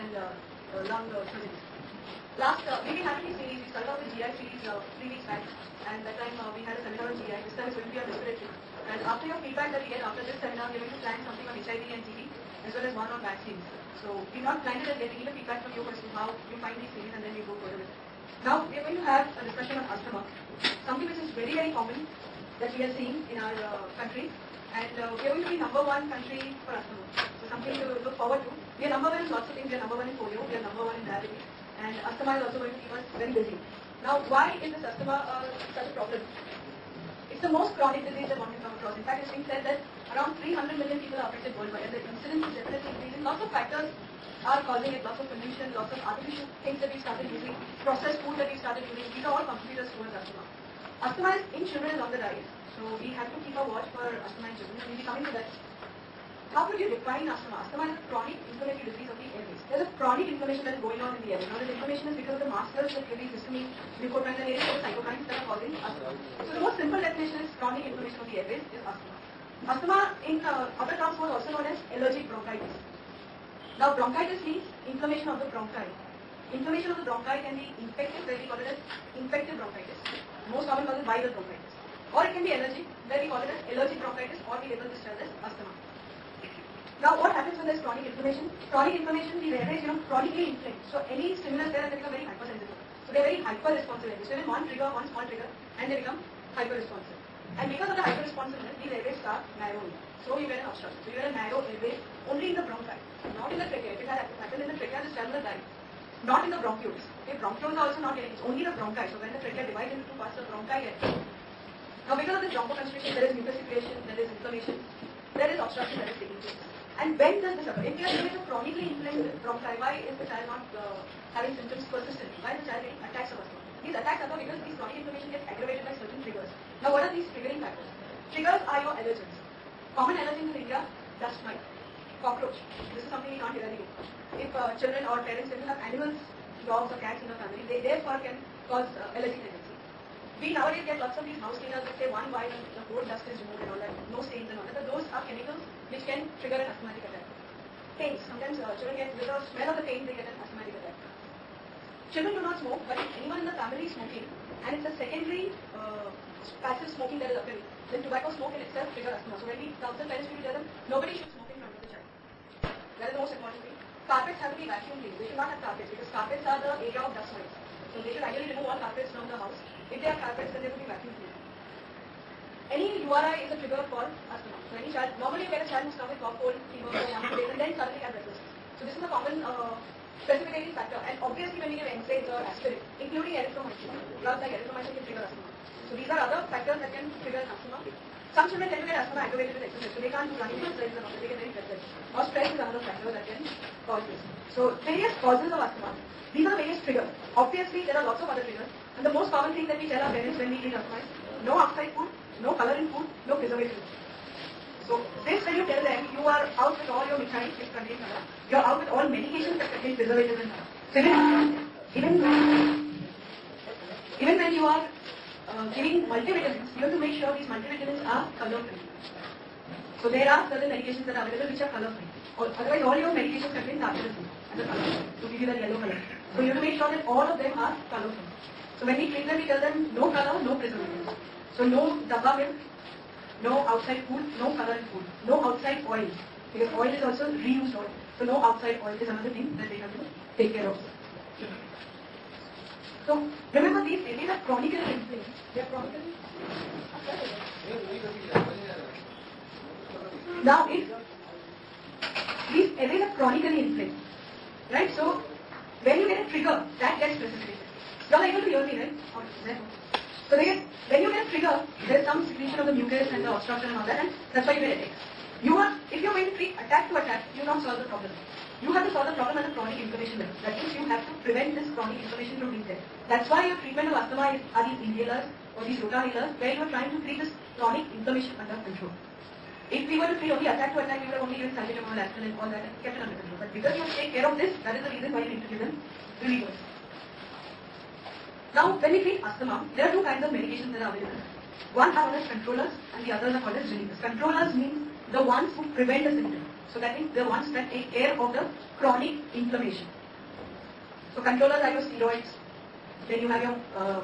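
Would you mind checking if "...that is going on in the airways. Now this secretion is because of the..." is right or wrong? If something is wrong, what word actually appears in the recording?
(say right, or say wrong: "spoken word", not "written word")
wrong: "inflammation", not "secretion".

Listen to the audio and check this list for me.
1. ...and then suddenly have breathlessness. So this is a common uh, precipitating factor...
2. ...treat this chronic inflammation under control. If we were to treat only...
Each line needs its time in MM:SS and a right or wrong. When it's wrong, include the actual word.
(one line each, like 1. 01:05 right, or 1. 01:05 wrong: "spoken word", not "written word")
1. 02:57 right
2. 04:37 right.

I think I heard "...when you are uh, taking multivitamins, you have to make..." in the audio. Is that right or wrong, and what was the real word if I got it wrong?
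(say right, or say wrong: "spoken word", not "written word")
wrong: "giving", not "taking".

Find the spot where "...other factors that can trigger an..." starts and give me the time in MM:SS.
03:06.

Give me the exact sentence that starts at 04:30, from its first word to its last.
That means you have to prevent this chronic inflammation from being there.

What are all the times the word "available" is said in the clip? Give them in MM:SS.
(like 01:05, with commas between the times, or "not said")
03:41, 04:50.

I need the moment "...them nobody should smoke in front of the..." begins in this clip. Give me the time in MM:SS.
02:40.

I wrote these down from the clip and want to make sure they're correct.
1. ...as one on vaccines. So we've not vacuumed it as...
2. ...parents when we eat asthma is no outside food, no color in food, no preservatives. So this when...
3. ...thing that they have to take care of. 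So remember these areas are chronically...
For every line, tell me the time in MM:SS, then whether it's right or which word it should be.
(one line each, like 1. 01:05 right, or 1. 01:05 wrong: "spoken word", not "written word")
1. 00:12 wrong: "planned", not "vacuumed"
2. 03:20 right
3. 03:59 right.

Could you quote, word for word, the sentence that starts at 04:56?
So that means the ones that take care of the chronic inflammation.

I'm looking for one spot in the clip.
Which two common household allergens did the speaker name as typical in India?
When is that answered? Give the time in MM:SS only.
02:11.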